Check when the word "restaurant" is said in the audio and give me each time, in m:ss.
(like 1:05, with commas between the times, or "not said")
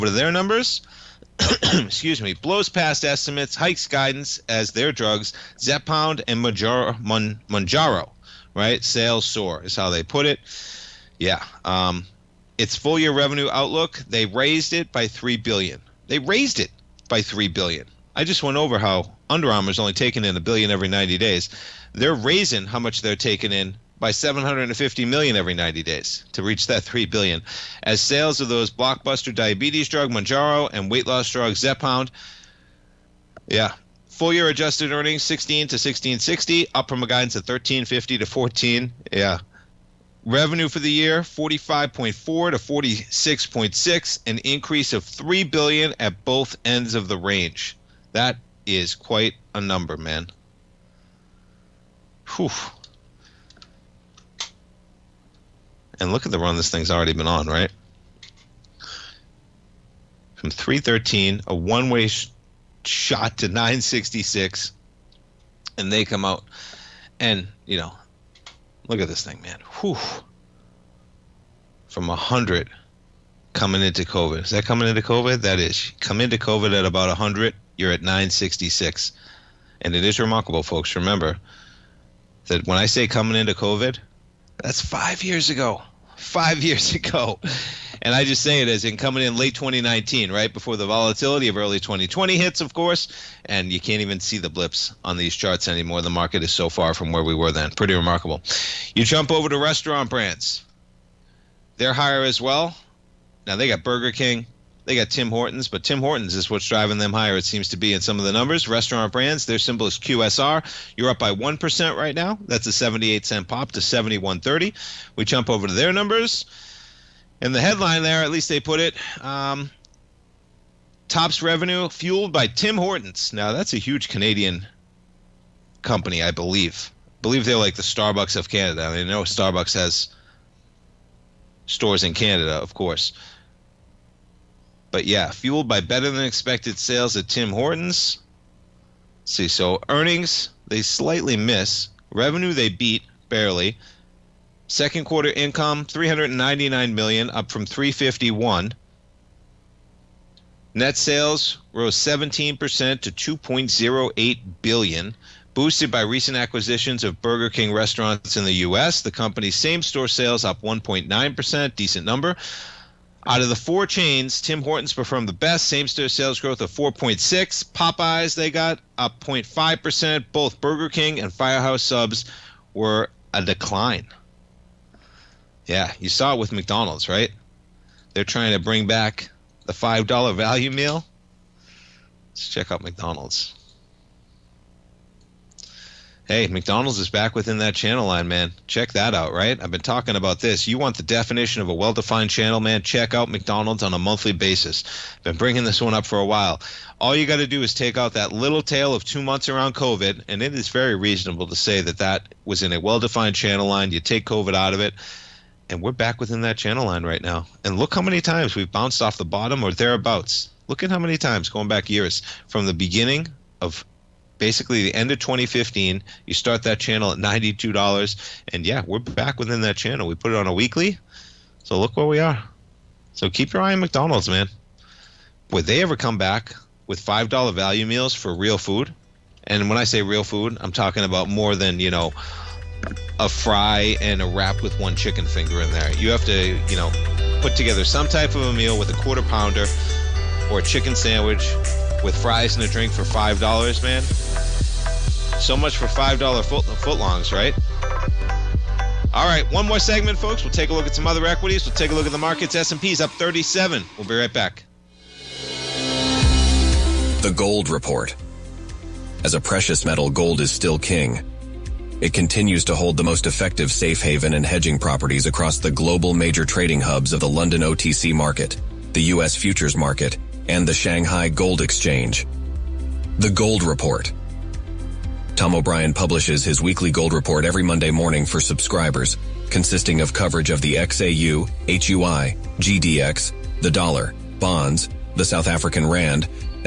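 1:39, 1:48, 2:37.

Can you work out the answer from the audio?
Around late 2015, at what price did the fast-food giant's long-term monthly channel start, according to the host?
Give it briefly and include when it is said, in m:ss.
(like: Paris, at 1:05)
$92, at 3:37.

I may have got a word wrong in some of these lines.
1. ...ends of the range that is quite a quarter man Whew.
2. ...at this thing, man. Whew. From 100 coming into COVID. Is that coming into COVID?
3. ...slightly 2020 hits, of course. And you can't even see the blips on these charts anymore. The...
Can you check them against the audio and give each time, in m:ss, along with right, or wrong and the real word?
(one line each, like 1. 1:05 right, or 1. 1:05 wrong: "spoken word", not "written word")
1. 0:46 wrong: "number", not "quarter"
2. 1:08 right
3. 1:31 wrong: "early", not "slightly".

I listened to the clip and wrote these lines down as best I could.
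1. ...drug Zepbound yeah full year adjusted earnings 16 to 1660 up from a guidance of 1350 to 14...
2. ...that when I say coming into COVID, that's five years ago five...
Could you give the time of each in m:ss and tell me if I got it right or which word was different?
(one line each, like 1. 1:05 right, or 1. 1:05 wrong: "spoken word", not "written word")
1. 0:31 right
2. 1:22 right.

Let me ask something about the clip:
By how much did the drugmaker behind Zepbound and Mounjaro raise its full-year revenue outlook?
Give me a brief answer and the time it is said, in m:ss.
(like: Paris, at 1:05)
$3 billion, at 0:14.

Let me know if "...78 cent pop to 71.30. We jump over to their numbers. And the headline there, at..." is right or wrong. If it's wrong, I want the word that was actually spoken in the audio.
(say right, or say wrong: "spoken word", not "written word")
right.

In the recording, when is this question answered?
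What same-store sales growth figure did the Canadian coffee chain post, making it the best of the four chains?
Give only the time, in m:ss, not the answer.
2:46.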